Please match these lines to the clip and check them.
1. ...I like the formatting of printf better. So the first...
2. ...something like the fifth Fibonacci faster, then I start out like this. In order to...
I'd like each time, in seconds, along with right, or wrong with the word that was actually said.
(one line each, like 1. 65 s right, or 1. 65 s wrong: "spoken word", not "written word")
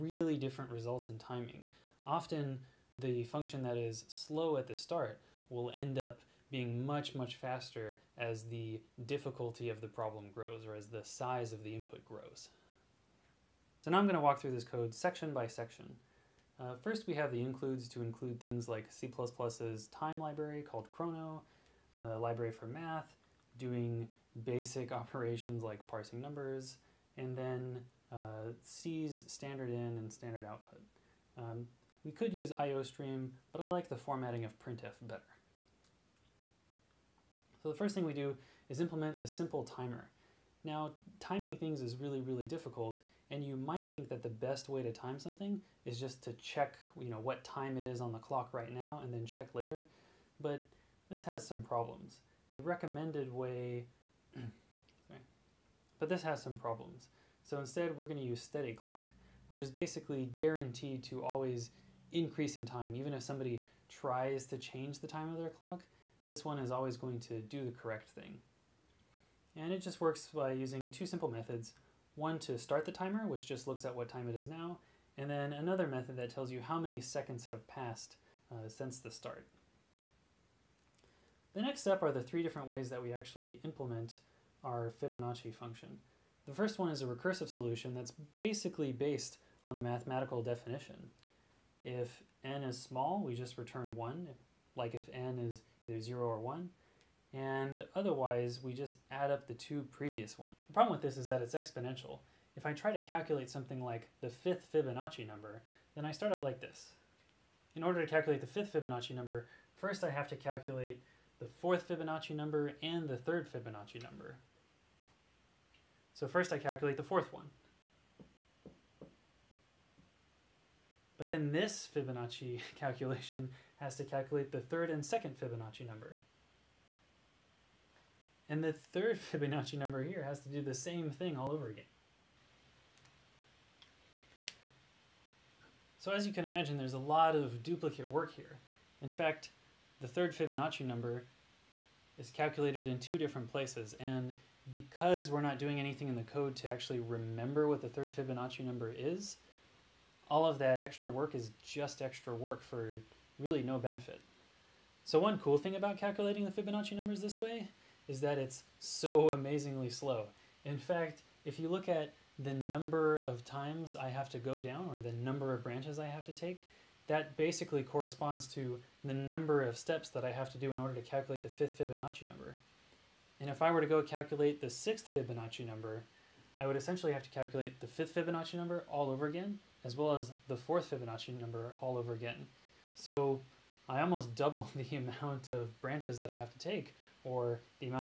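1. 33 s right
2. 103 s wrong: "number", not "faster".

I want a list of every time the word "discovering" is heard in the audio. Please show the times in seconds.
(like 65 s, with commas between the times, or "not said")
not said.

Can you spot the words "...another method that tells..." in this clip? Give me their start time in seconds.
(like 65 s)
75 s.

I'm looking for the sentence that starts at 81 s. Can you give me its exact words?
The next step are the three different ways that we actually implement our Fibonacci function.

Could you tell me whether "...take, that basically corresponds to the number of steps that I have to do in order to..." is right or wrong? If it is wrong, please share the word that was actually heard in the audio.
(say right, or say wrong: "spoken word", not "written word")
right.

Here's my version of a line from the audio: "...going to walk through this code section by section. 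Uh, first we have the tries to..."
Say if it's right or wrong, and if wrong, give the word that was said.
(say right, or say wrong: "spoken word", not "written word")
wrong: "includes", not "tries".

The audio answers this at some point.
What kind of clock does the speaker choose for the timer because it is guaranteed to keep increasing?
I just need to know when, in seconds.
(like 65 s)
58 s.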